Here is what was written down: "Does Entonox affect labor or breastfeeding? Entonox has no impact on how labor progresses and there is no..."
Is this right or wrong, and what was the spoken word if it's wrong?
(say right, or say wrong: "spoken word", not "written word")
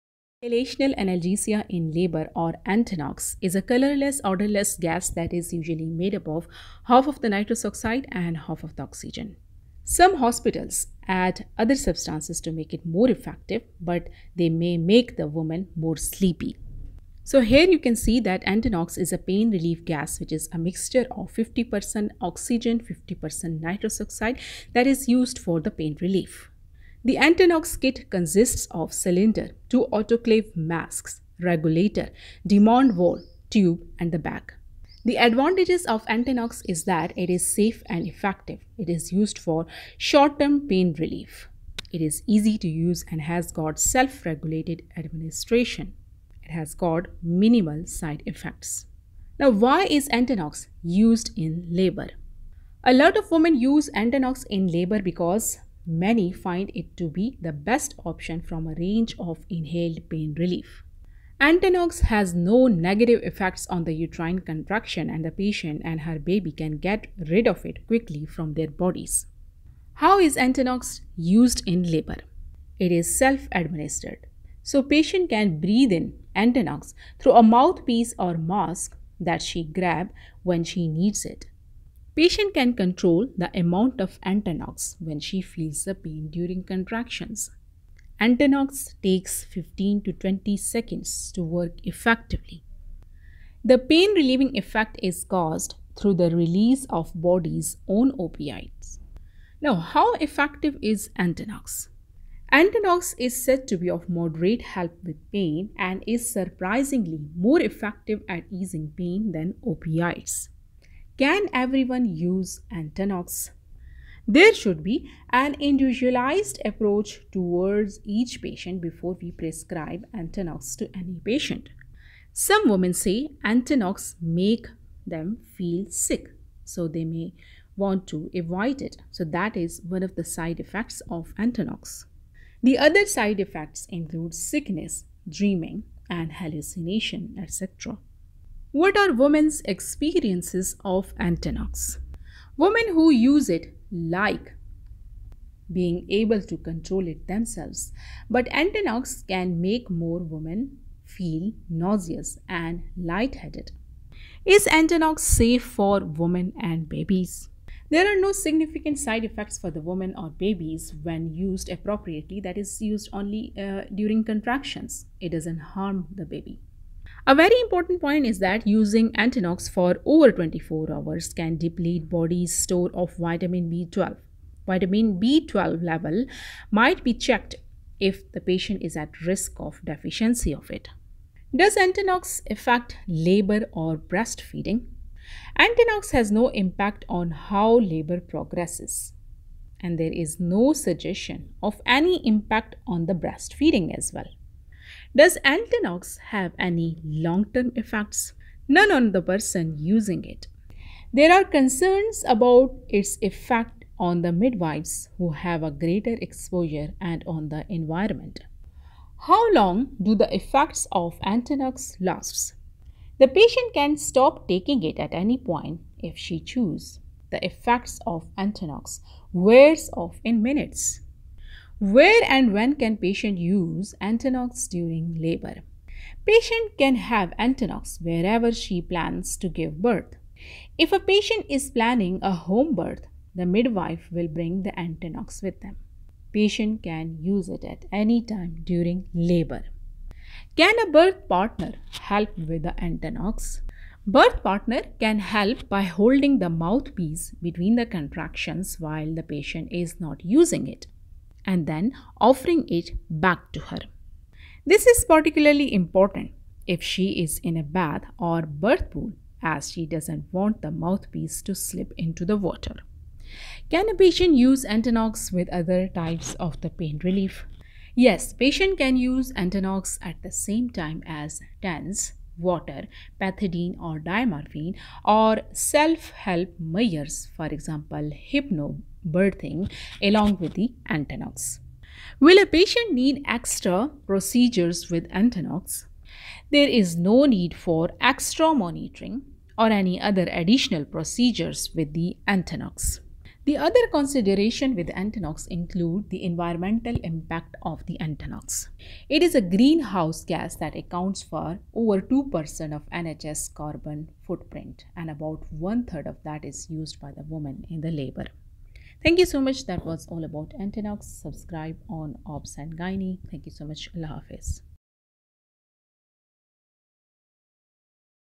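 right.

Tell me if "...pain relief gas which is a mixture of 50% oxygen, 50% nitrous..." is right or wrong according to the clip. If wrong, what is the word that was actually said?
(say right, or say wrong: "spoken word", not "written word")
right.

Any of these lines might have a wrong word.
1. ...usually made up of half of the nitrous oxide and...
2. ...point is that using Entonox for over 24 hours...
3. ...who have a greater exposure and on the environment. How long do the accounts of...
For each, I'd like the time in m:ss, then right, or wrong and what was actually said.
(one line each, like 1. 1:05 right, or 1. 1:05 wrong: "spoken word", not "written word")
1. 0:05 right
2. 2:48 right
3. 3:25 wrong: "effects", not "accounts".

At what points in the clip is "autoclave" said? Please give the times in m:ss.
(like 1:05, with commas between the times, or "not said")
0:29.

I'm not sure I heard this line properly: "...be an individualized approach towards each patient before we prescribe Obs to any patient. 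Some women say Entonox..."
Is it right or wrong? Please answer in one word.
wrong.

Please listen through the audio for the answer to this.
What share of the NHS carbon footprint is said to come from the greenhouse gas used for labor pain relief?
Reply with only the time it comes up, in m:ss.
5:01.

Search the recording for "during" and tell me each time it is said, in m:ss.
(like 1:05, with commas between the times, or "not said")
1:26, 2:43, 3:44, 3:58.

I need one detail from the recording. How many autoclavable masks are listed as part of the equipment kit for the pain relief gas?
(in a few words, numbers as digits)
2.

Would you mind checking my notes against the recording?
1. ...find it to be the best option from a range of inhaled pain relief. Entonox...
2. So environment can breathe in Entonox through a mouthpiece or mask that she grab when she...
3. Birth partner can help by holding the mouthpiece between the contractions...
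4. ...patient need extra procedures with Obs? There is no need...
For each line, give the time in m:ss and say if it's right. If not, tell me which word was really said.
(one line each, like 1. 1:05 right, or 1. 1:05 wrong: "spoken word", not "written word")
1. 0:56 right
2. 1:14 wrong: "patient", not "environment"
3. 4:04 right
4. 4:42 wrong: "Entonox", not "Obs".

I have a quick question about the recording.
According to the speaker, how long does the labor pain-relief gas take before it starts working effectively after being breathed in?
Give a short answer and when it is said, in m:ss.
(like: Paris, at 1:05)
15 to 20 seconds, at 1:29.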